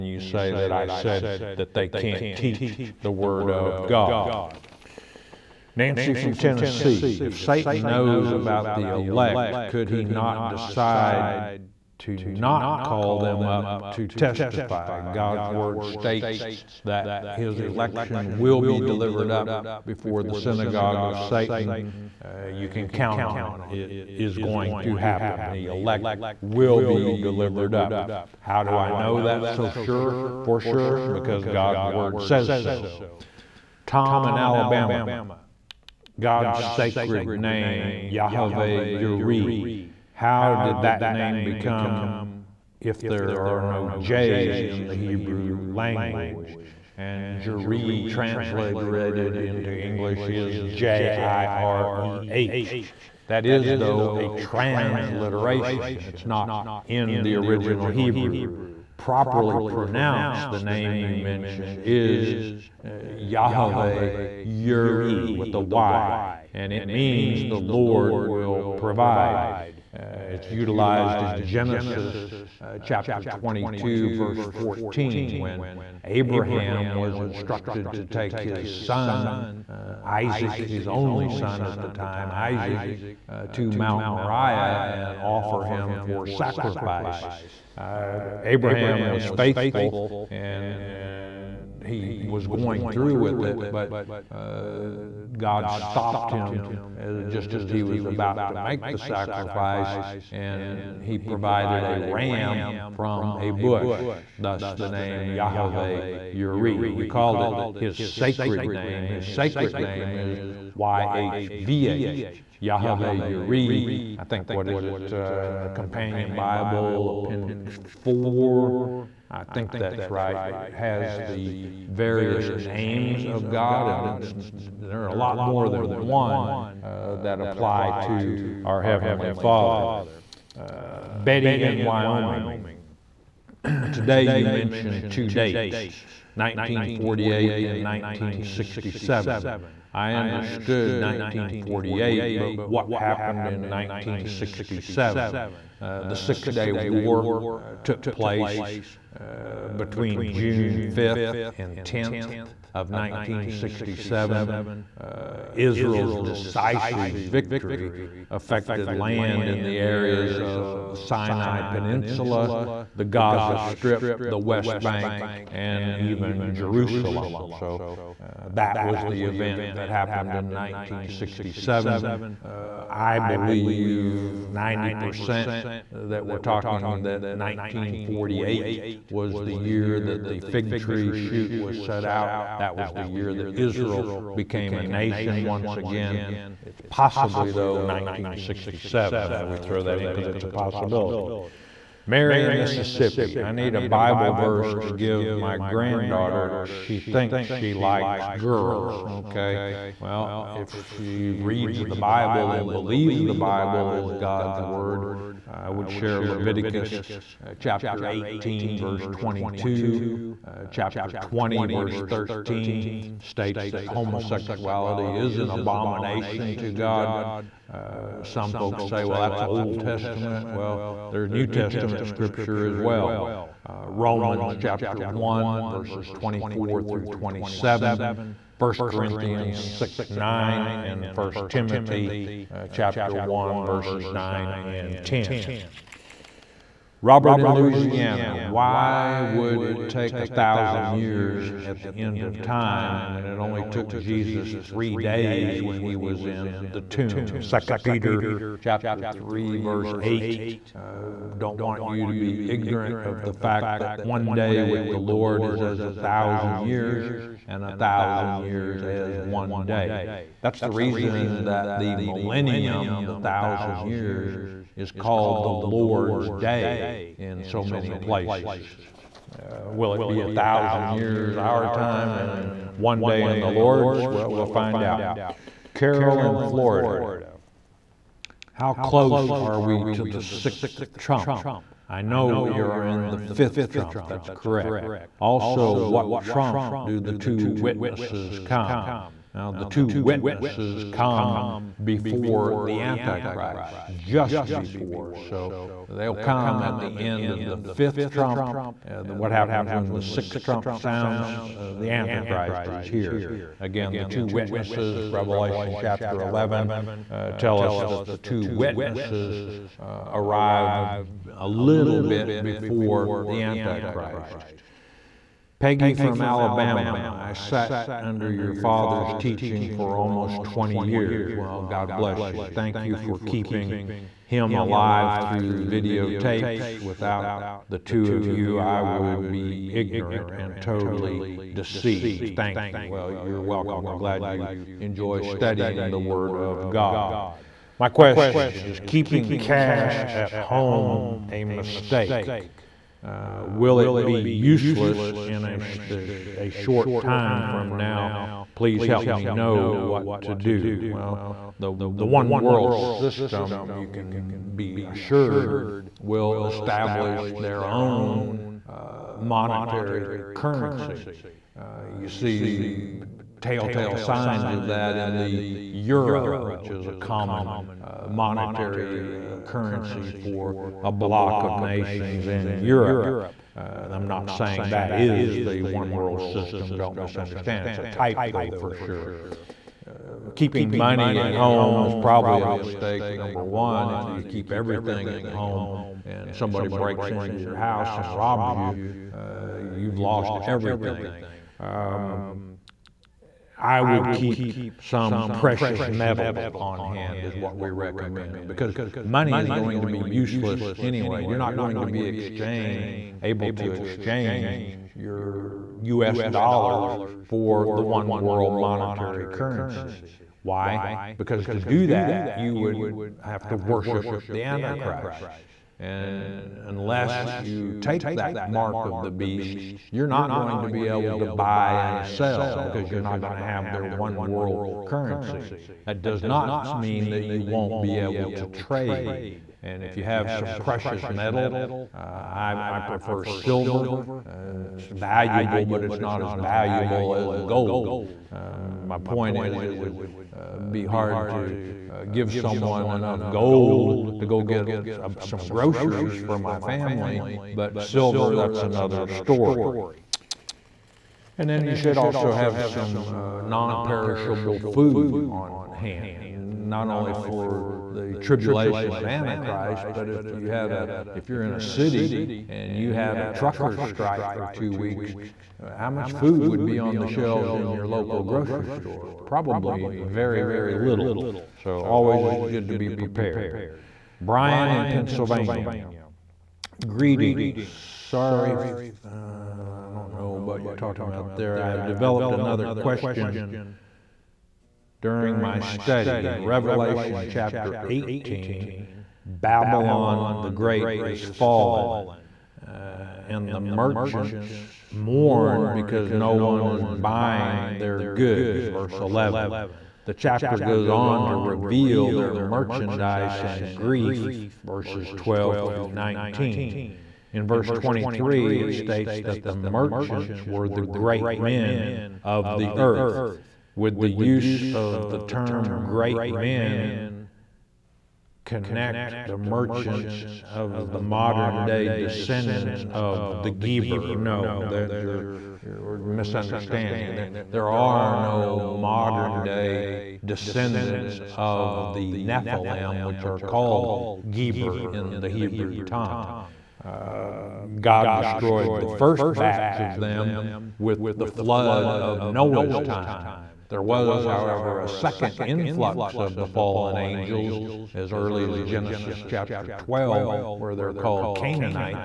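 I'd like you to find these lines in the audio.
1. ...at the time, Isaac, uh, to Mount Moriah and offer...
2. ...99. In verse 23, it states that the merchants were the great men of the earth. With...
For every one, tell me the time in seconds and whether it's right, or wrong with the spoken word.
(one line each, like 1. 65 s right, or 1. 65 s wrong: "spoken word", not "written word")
1. 81 s right
2. 505 s wrong: "19", not "99".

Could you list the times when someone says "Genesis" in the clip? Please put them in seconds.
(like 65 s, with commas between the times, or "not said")
71 s, 548 s.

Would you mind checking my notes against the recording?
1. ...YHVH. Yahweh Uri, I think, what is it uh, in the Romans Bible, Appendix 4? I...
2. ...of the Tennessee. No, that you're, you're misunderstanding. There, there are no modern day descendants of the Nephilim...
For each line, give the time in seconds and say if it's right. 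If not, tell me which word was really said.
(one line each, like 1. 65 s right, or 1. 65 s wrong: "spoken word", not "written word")
1. 110 s wrong: "Companion", not "Romans"
2. 522 s wrong: "Geber", not "Tennessee".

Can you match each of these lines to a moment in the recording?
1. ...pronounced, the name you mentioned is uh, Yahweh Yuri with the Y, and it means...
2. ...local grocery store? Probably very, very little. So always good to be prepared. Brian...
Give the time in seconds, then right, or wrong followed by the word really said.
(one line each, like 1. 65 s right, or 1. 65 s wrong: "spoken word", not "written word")
1. 59 s right
2. 467 s right.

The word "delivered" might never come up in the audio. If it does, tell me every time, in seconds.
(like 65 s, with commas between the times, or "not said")
18 s, 27 s.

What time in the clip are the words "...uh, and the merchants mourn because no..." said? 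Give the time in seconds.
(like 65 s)
492 s.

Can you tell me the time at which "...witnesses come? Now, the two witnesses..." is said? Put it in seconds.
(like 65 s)
287 s.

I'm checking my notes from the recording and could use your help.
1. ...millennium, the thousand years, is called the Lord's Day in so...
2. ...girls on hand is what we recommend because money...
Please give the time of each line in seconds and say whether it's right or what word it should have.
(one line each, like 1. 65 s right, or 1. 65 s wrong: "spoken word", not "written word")
1. 261 s right
2. 395 s wrong: "metals", not "girls".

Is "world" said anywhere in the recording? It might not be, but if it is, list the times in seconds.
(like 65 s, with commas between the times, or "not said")
352 s, 375 s, 408 s, 424 s.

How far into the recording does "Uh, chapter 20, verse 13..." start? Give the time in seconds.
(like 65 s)
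210 s.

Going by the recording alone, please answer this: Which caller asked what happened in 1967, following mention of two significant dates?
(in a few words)
Betty in Wyoming.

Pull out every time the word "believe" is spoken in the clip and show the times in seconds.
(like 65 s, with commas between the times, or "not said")
173 s, 202 s.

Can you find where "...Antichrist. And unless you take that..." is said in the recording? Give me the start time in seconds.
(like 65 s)
414 s.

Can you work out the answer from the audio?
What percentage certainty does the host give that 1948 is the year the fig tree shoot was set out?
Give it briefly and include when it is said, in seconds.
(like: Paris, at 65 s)
90%, at 174 s.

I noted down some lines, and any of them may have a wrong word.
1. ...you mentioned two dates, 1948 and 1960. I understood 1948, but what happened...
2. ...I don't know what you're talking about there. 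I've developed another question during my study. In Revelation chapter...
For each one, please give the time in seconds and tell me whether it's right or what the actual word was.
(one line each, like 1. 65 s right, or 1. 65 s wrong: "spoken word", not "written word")
1. 134 s wrong: "1967", not "1960"
2. 479 s right.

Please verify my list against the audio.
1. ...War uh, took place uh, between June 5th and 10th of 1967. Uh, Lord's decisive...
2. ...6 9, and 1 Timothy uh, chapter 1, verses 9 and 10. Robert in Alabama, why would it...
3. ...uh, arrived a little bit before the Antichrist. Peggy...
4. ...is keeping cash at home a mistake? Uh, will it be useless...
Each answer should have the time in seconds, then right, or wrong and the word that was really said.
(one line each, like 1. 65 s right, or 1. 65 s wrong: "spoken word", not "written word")
1. 146 s wrong: "Israel", not "Lord"
2. 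229 s wrong: "Louisiana", not "Alabama"
3. 309 s right
4. 338 s right.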